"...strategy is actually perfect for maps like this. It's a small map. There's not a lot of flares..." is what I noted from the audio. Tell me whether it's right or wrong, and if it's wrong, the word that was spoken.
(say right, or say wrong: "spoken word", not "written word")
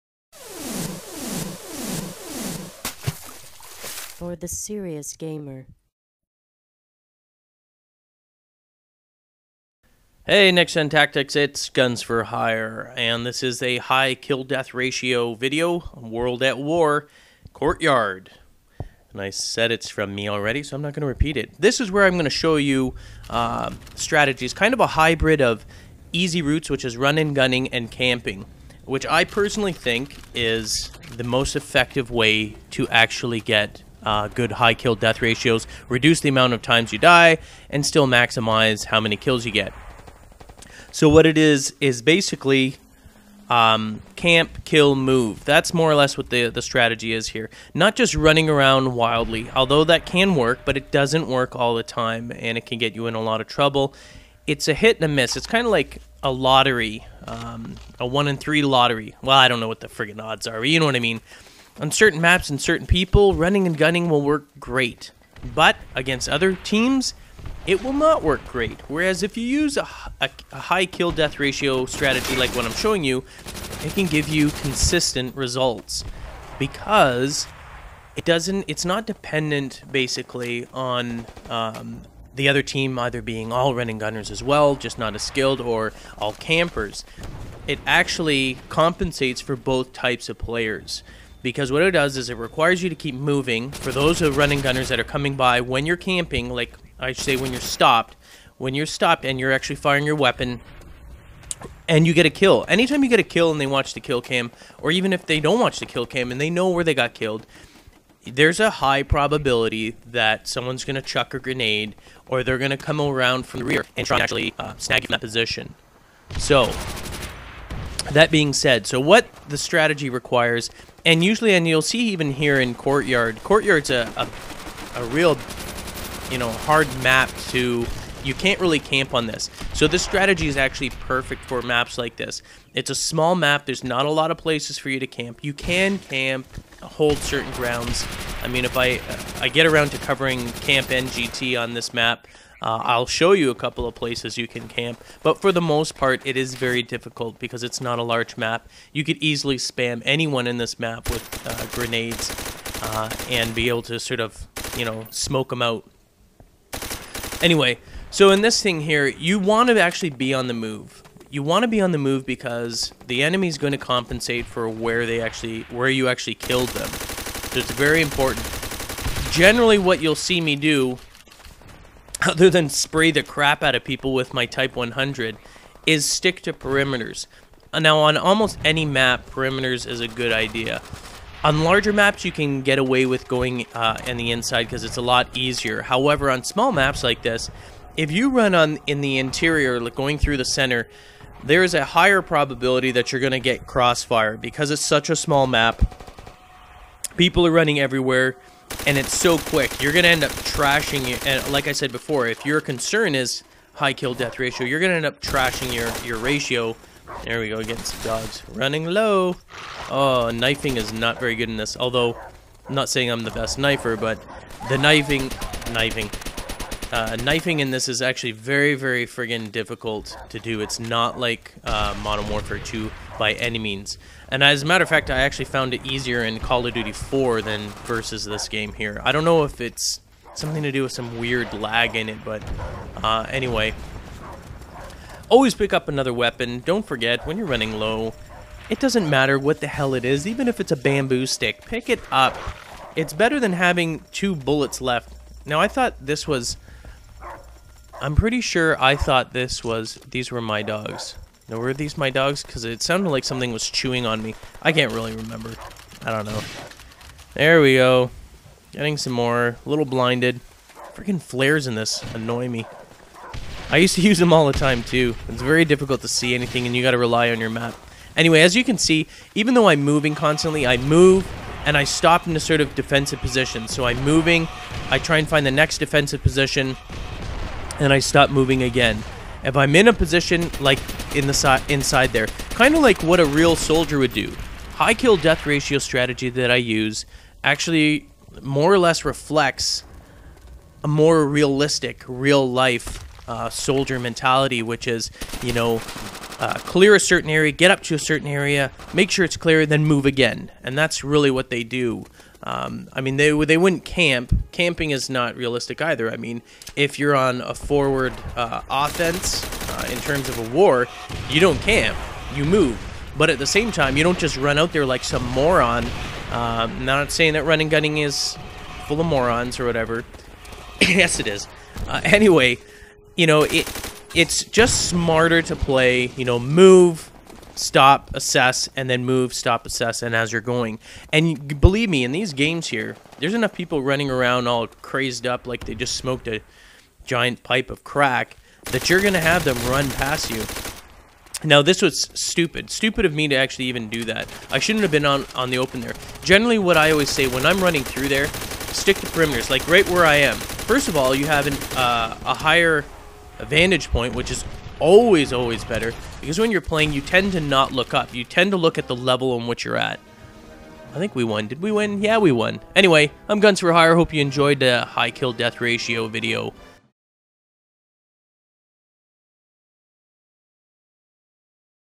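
wrong: "places", not "flares".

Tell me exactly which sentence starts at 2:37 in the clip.
Anyway, so in this thing here, you want to actually be on the move.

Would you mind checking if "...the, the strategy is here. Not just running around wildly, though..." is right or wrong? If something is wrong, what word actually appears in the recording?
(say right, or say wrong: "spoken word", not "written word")
wrong: "although", not "though".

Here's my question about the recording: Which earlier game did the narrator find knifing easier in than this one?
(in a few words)
Call of Duty 4.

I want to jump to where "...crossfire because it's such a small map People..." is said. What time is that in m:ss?
3:13.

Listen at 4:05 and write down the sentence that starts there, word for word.
Now, I thought this was I'm pretty sure I thought this was these were my dogs.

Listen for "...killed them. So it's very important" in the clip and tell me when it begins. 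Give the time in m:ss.
2:46.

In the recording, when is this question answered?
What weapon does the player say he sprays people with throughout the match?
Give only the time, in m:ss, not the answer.
2:54.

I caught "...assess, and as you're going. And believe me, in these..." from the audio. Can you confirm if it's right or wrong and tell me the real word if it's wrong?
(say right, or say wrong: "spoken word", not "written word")
right.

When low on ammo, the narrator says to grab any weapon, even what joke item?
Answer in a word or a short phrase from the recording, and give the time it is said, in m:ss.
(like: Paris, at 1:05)
bamboo stick, at 4:00.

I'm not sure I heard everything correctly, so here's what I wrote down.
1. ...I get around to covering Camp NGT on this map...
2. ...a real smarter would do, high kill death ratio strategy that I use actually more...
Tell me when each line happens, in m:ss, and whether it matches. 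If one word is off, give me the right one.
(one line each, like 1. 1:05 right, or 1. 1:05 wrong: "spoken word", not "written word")
1. 2:19 right
2. 4:43 wrong: "soldier", not "smarter".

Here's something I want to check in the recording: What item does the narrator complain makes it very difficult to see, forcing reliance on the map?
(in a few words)
flares.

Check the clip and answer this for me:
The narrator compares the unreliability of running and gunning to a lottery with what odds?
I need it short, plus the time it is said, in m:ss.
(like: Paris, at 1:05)
1 in 3, at 0:58.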